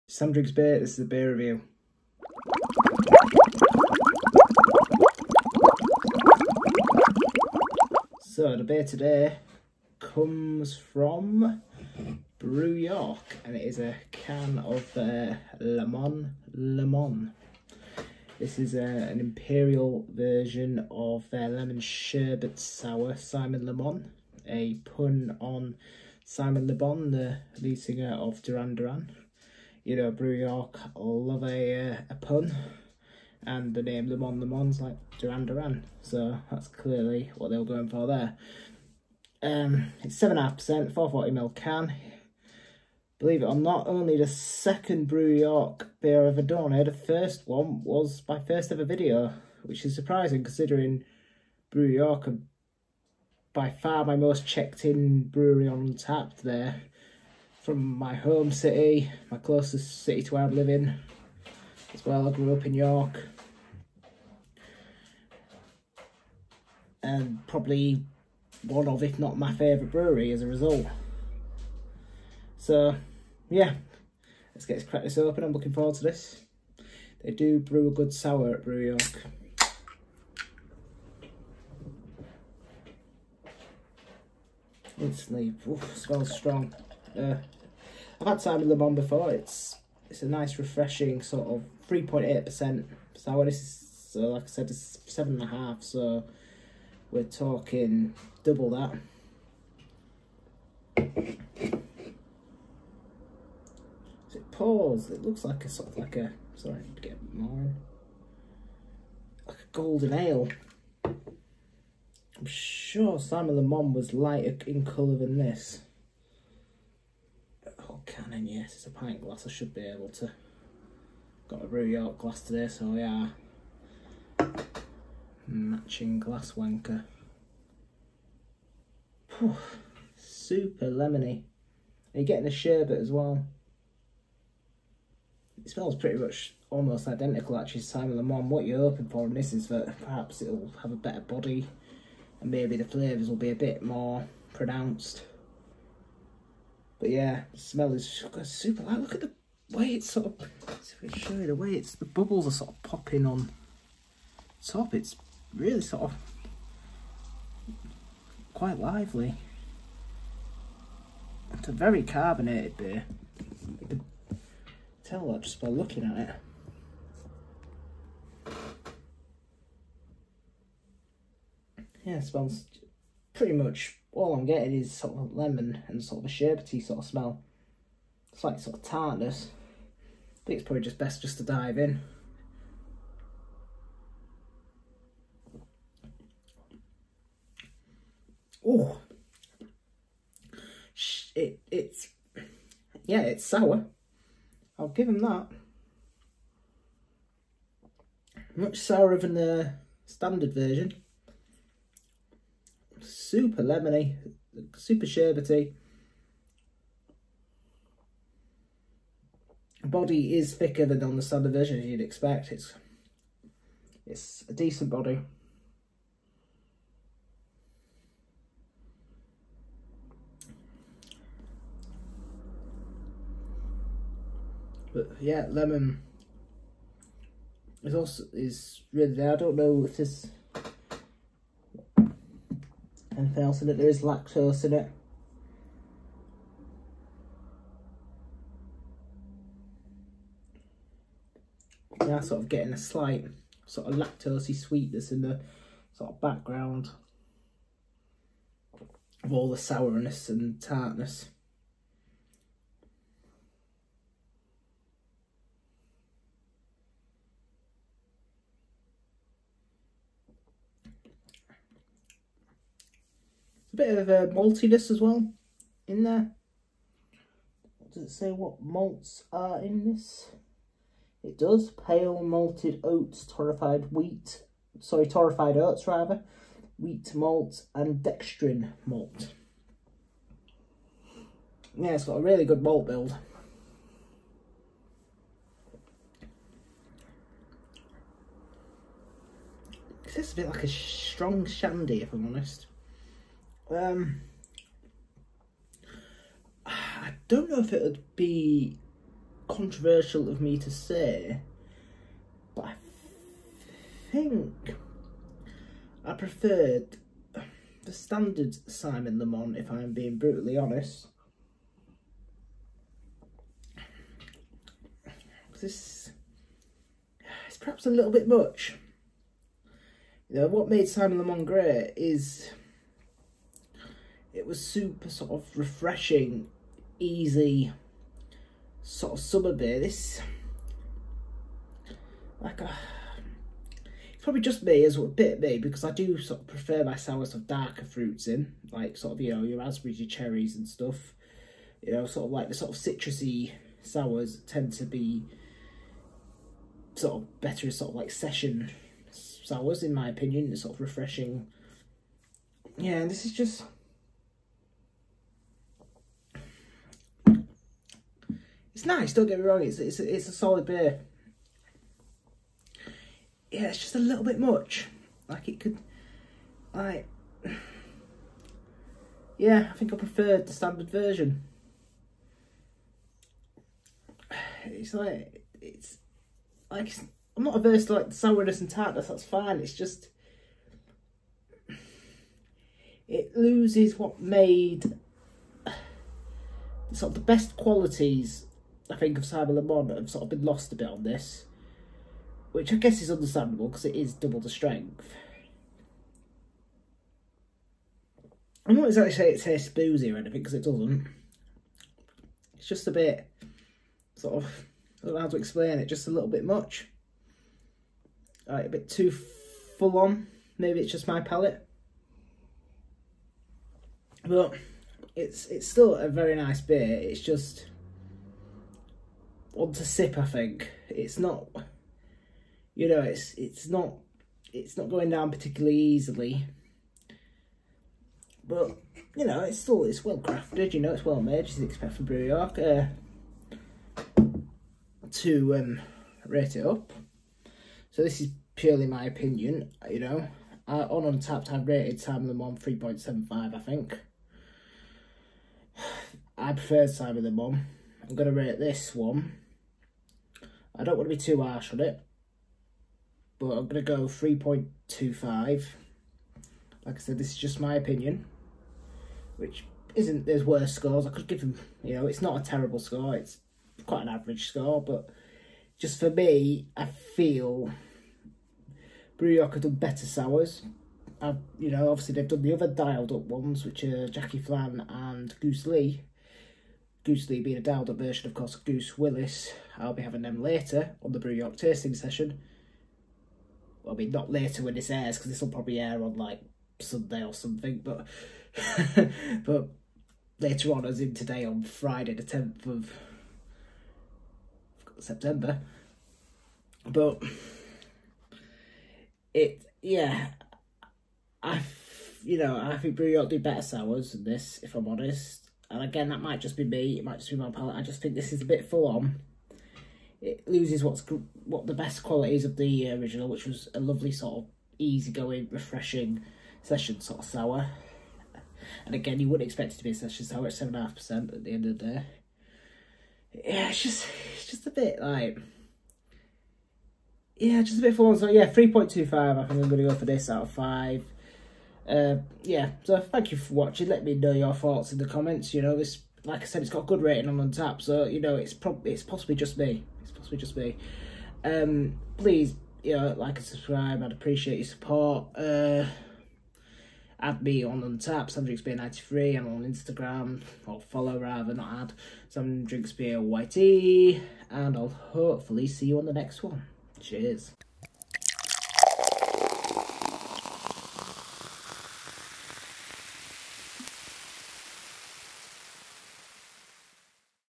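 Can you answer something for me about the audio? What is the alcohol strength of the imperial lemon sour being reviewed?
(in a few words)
7.5%.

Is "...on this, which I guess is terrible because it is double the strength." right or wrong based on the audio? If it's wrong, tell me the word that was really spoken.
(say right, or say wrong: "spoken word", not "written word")
wrong: "understandable", not "terrible".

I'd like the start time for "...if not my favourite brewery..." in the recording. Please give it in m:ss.
1:09.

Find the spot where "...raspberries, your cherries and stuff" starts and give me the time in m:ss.
5:39.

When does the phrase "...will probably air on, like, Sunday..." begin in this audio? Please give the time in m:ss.
8:05.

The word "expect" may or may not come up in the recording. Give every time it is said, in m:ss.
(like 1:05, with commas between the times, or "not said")
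3:32, 7:11, 8:39.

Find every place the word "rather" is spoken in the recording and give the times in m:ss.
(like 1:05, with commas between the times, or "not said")
4:35, 9:11.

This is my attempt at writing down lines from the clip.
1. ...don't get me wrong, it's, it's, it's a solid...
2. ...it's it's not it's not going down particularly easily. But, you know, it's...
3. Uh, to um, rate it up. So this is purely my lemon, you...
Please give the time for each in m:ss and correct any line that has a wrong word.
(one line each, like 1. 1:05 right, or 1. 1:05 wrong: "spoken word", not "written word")
1. 5:59 right
2. 7:03 right
3. 7:12 wrong: "opinion", not "lemon".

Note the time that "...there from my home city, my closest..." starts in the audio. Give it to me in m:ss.
0:56.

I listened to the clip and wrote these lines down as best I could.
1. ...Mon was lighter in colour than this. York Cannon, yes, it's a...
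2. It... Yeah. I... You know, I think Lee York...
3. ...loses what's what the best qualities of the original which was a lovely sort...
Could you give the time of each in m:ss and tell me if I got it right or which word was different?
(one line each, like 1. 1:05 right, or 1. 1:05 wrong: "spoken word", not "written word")
1. 1:53 right
2. 8:19 wrong: "Brew", not "Lee"
3. 8:30 right.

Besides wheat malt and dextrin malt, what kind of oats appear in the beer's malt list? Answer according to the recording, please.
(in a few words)
torrified oats.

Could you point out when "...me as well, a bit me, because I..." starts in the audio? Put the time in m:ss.
5:34.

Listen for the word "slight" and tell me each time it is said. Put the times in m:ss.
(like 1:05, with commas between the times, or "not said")
2:58, 4:02.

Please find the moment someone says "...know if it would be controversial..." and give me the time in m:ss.
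4:57.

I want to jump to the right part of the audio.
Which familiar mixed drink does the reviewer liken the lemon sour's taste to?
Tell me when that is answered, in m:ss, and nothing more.
4:50.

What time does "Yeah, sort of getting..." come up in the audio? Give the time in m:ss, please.
4:02.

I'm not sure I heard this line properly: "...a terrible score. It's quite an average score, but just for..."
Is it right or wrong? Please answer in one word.
right.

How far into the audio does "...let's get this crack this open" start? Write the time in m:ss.
1:14.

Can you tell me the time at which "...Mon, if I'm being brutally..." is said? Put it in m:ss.
5:09.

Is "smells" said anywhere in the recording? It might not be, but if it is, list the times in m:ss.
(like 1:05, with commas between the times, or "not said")
1:25, 2:15, 2:27, 2:52, 2:57.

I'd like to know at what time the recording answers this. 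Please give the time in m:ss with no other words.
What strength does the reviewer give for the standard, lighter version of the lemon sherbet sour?
1:31.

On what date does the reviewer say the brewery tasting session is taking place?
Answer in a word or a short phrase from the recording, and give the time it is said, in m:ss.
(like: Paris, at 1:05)
Friday 10 September, at 8:11.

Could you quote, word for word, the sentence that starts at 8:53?
Let me know your thoughts in the comments.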